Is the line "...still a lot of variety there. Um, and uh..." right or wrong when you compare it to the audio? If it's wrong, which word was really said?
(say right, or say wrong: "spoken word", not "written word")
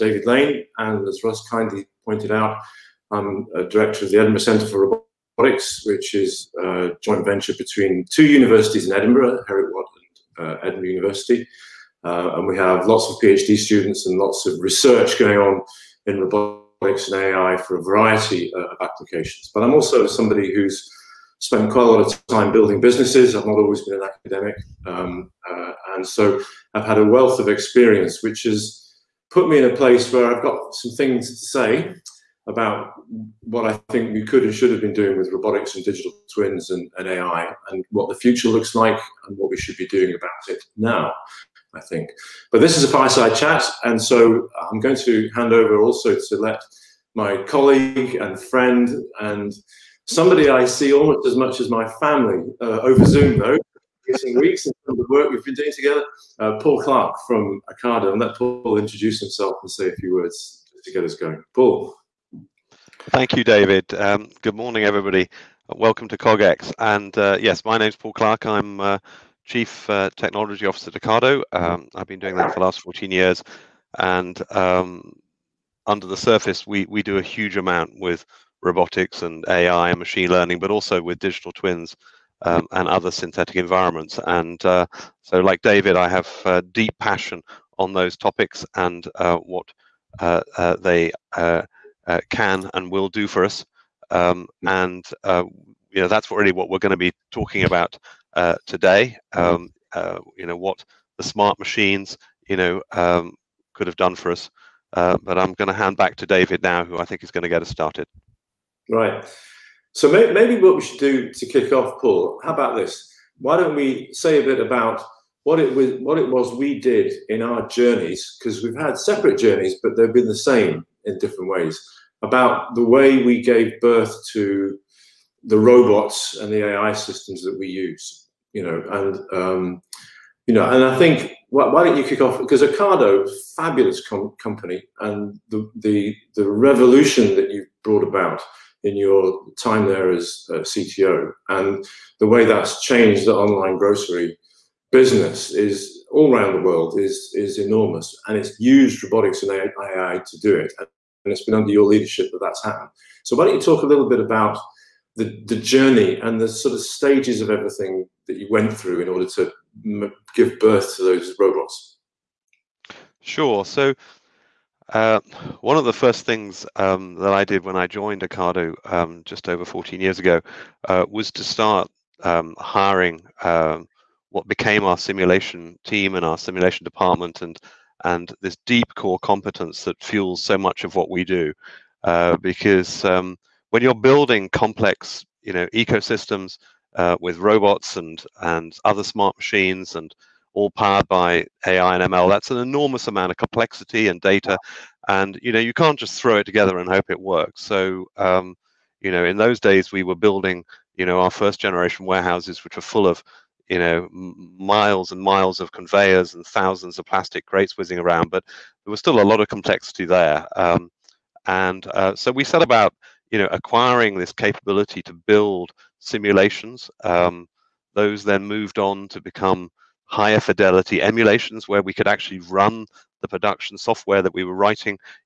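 wrong: "complexity", not "variety".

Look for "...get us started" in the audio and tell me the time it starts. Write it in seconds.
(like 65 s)
107 s.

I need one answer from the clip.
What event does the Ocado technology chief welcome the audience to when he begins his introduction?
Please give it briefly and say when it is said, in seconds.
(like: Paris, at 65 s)
CogX, at 66 s.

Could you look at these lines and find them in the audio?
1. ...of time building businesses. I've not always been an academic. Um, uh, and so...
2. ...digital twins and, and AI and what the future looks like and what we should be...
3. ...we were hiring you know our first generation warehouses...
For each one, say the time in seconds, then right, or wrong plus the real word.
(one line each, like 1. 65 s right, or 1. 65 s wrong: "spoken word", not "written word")
1. 22 s right
2. 35 s right
3. 199 s wrong: "building", not "hiring".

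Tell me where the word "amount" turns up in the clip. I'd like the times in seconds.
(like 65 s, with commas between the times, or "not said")
77 s, 193 s.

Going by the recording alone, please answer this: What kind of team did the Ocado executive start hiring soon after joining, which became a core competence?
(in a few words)
simulation team.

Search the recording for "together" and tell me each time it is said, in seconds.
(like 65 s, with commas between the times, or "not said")
55 s, 196 s.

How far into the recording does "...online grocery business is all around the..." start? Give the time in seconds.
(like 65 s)
143 s.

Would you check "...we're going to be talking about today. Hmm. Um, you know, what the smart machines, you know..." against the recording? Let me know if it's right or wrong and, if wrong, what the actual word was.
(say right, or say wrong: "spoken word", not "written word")
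right.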